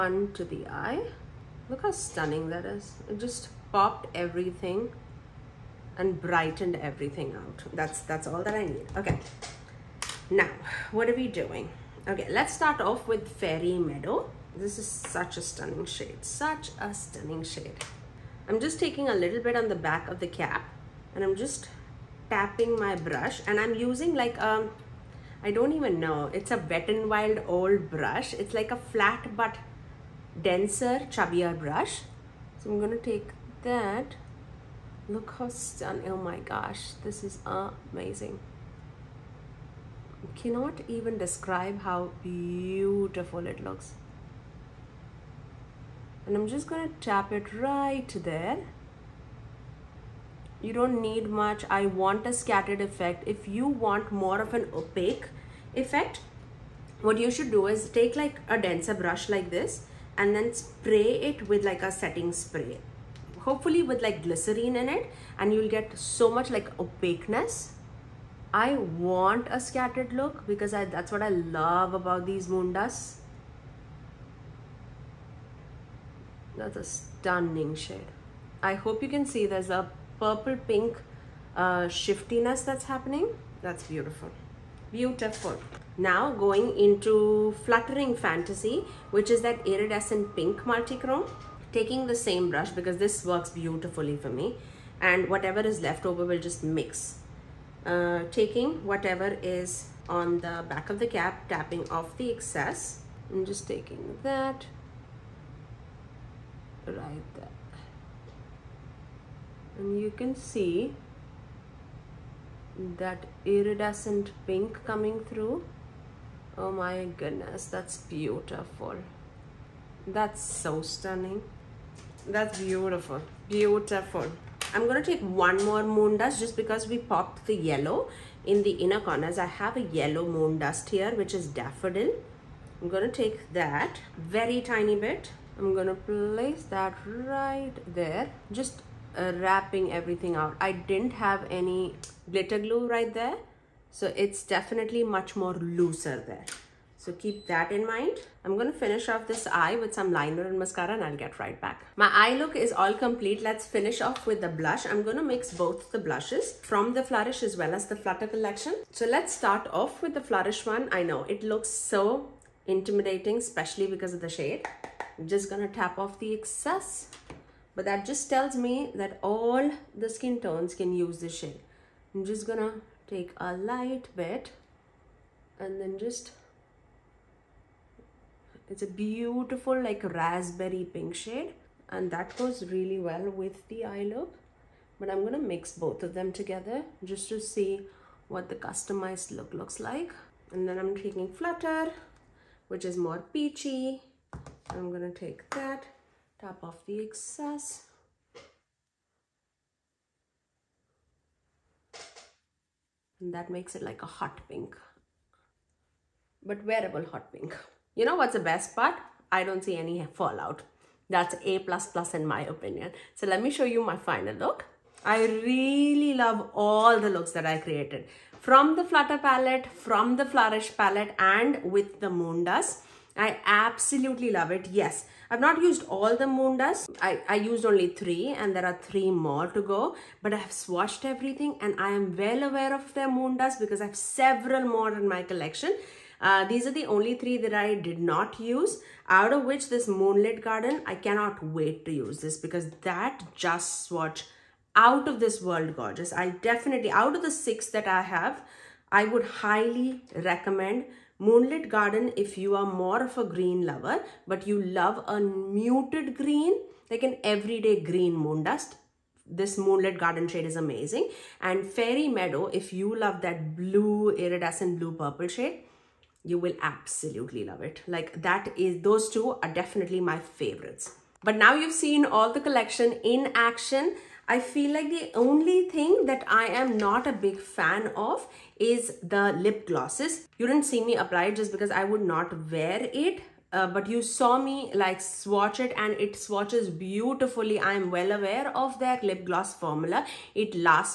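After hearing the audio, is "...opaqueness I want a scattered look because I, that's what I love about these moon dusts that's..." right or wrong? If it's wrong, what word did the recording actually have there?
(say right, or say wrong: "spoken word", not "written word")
right.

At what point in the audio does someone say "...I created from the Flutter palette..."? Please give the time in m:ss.
3:37.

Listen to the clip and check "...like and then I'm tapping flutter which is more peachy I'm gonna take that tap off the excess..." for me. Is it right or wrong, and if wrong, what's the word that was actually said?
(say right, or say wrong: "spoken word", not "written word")
wrong: "taking", not "tapping".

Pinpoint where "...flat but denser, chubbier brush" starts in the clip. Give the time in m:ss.
0:28.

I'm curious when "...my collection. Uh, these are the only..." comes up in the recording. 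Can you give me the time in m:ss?
3:55.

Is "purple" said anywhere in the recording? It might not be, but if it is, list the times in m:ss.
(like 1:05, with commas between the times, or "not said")
1:20, 4:24.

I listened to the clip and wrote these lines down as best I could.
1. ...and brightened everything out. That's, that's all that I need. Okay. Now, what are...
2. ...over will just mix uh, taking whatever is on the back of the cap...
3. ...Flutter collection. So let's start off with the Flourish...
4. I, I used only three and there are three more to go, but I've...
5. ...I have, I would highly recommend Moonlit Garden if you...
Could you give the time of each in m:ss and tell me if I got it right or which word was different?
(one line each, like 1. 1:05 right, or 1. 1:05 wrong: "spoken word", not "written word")
1. 0:05 right
2. 1:36 right
3. 2:37 right
4. 3:47 right
5. 4:07 right.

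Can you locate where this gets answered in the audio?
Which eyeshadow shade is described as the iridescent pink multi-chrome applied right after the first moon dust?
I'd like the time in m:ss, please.
1:27.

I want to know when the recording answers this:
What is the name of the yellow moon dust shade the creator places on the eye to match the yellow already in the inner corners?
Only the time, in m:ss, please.
2:11.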